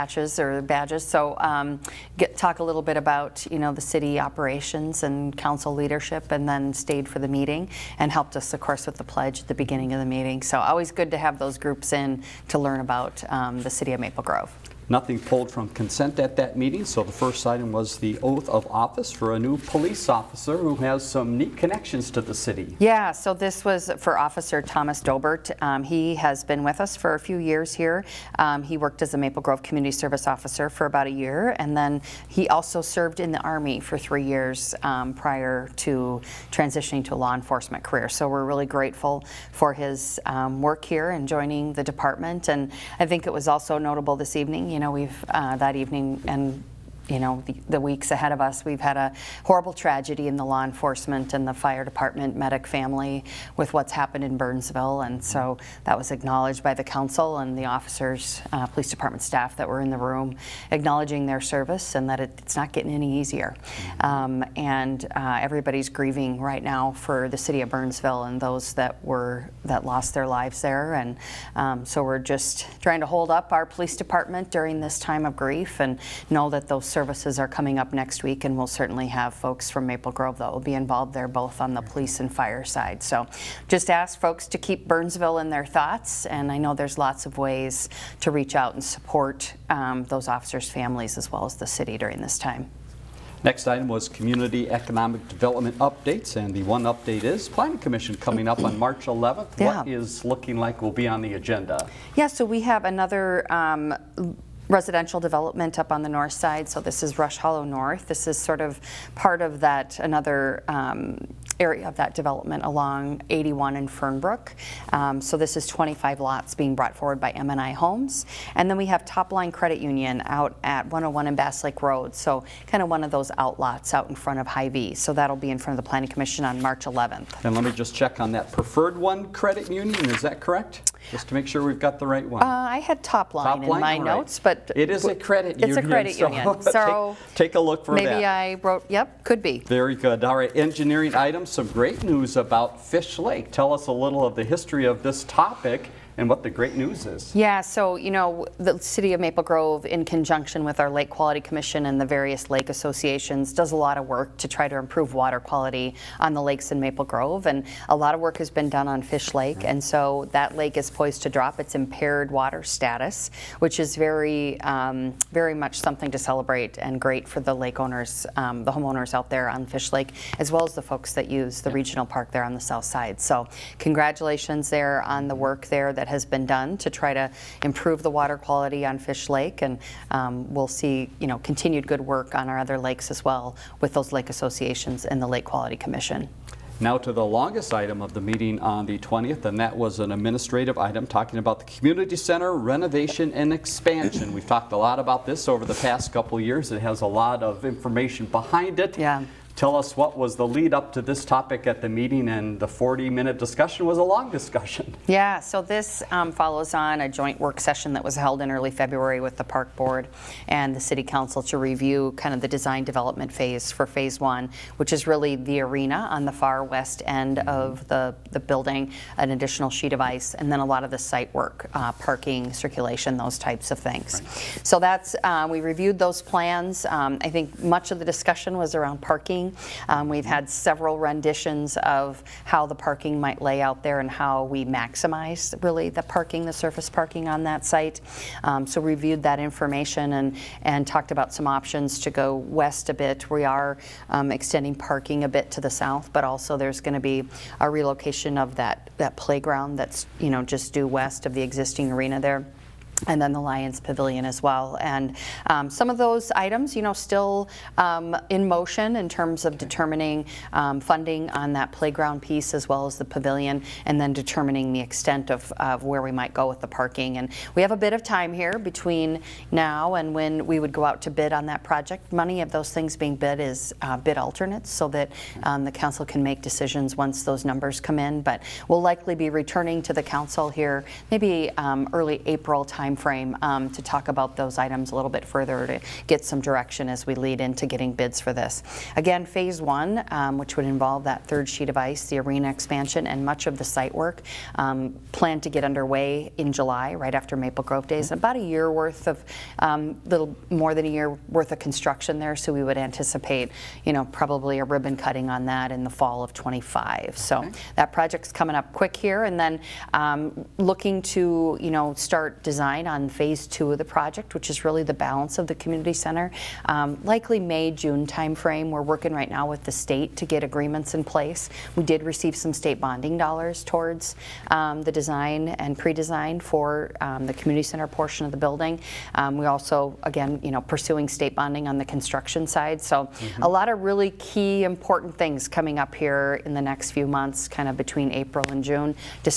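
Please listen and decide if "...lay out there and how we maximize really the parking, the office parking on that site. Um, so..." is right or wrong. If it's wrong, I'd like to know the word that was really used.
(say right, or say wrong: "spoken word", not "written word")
wrong: "surface", not "office".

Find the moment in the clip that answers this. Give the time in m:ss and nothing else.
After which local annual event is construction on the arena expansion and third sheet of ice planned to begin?
4:57.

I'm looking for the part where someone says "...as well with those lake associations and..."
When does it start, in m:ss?
3:03.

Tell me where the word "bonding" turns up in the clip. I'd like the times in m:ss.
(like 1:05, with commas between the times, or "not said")
5:22, 5:31.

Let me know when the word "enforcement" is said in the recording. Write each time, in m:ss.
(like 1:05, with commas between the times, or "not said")
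0:37, 0:50.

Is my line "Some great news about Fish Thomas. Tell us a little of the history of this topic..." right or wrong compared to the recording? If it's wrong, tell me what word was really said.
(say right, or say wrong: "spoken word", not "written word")
wrong: "Lake", not "Thomas".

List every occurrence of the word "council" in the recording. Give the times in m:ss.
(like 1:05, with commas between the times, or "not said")
0:05, 0:56, 3:31, 4:35, 4:40.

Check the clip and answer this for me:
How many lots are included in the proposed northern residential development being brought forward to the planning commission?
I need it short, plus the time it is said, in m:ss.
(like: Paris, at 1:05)
25, at 1:55.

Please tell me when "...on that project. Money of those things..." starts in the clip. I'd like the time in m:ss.
4:31.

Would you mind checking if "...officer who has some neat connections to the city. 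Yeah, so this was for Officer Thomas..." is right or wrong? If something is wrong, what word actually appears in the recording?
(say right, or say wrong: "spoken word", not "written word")
right.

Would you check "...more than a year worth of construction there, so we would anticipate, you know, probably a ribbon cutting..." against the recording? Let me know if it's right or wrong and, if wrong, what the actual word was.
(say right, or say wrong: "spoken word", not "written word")
right.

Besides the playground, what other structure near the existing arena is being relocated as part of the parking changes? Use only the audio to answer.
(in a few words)
Lions Pavilion.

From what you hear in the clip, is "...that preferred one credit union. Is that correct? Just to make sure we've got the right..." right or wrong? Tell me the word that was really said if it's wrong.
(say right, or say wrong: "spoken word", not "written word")
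right.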